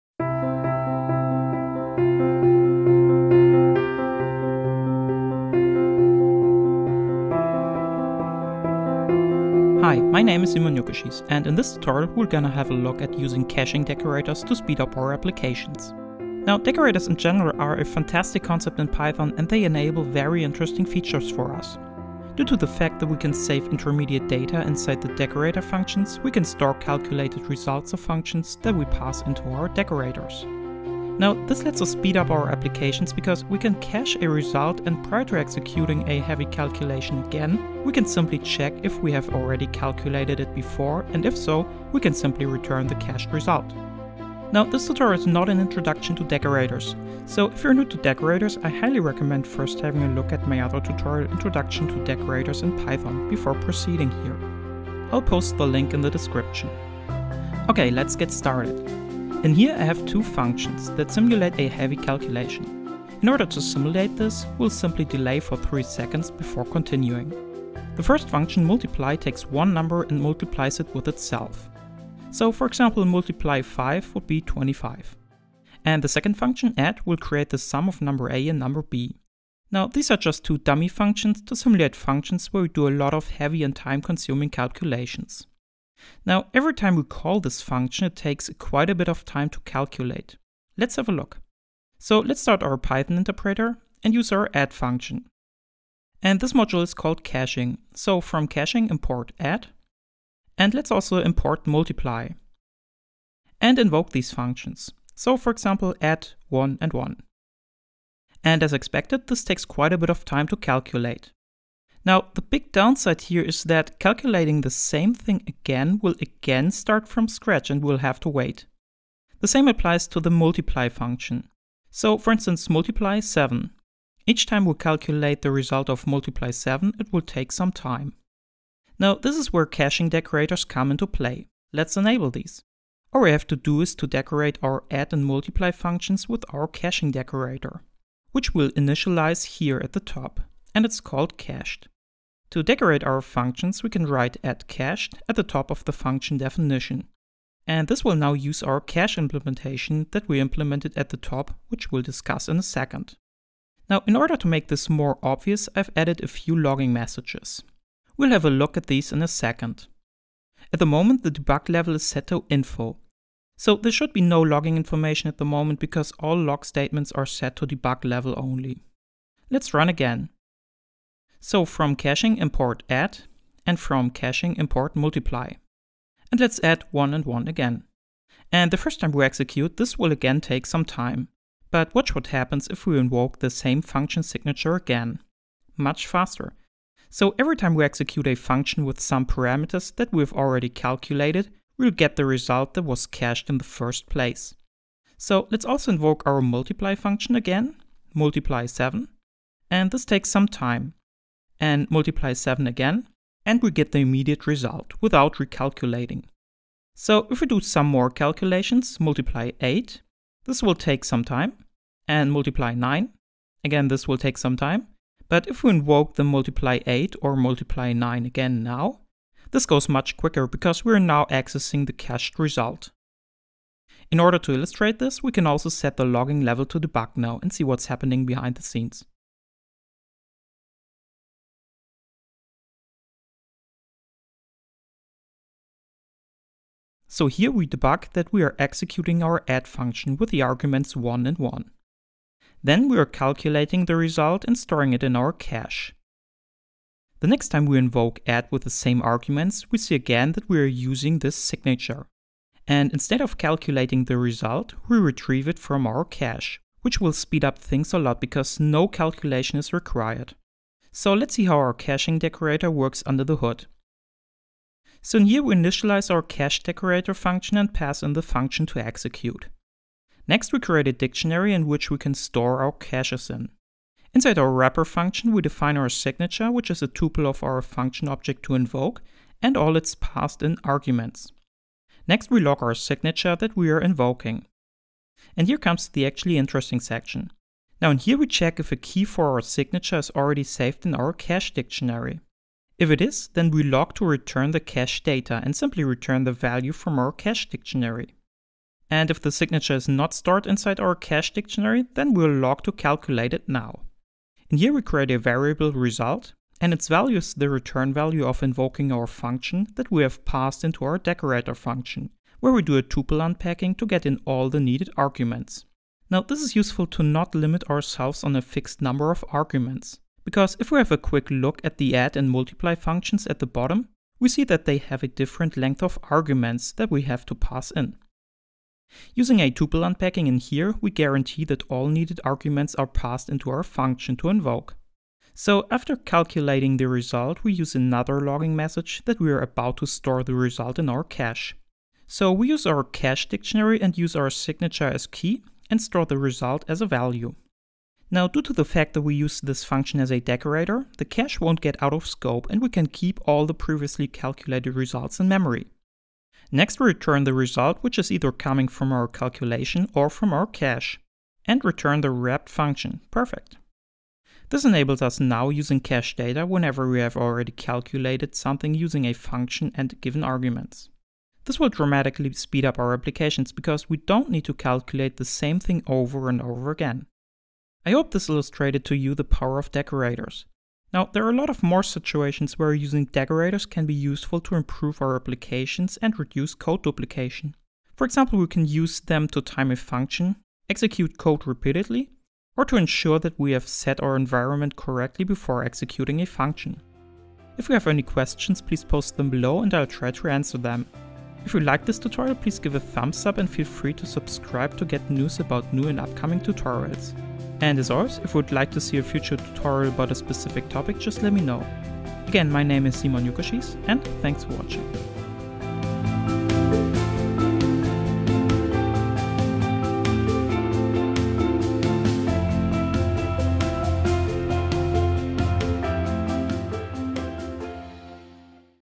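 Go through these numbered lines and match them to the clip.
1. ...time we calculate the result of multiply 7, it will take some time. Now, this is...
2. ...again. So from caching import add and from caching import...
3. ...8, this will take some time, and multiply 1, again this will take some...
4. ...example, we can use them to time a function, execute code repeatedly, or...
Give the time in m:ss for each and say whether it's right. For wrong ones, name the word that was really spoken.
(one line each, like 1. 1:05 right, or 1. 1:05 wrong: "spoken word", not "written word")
1. 2:04 right
2. 2:49 right
3. 3:29 wrong: "9", not "1"
4. 6:28 right.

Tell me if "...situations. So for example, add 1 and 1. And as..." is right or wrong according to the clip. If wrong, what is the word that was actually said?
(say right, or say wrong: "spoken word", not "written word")
wrong: "functions", not "situations".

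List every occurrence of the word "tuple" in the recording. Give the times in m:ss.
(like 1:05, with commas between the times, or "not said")
4:36, 5:12, 5:29.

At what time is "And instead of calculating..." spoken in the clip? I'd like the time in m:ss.
4:12.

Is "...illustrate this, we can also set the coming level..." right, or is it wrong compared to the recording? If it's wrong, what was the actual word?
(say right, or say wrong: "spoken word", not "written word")
wrong: "logging", not "coming".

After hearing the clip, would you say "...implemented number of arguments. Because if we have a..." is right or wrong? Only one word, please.
wrong.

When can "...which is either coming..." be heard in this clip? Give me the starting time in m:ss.
5:57.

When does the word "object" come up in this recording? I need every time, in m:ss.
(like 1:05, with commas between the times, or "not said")
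4:38.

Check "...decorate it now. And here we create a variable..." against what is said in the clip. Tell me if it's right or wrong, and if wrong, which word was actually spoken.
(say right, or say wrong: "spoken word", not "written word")
wrong: "calculate", not "decorate".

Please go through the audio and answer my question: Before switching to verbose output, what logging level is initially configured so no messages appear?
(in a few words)
info.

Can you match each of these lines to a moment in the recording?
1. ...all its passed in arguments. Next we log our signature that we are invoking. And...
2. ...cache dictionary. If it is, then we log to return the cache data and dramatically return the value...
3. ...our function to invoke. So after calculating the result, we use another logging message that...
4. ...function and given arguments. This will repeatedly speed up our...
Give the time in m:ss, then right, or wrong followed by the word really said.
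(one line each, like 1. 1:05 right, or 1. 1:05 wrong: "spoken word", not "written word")
1. 4:39 right
2. 4:51 wrong: "simply", not "dramatically"
3. 5:33 right
4. 6:09 wrong: "dramatically", not "repeatedly".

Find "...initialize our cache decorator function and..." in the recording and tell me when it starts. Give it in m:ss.
4:25.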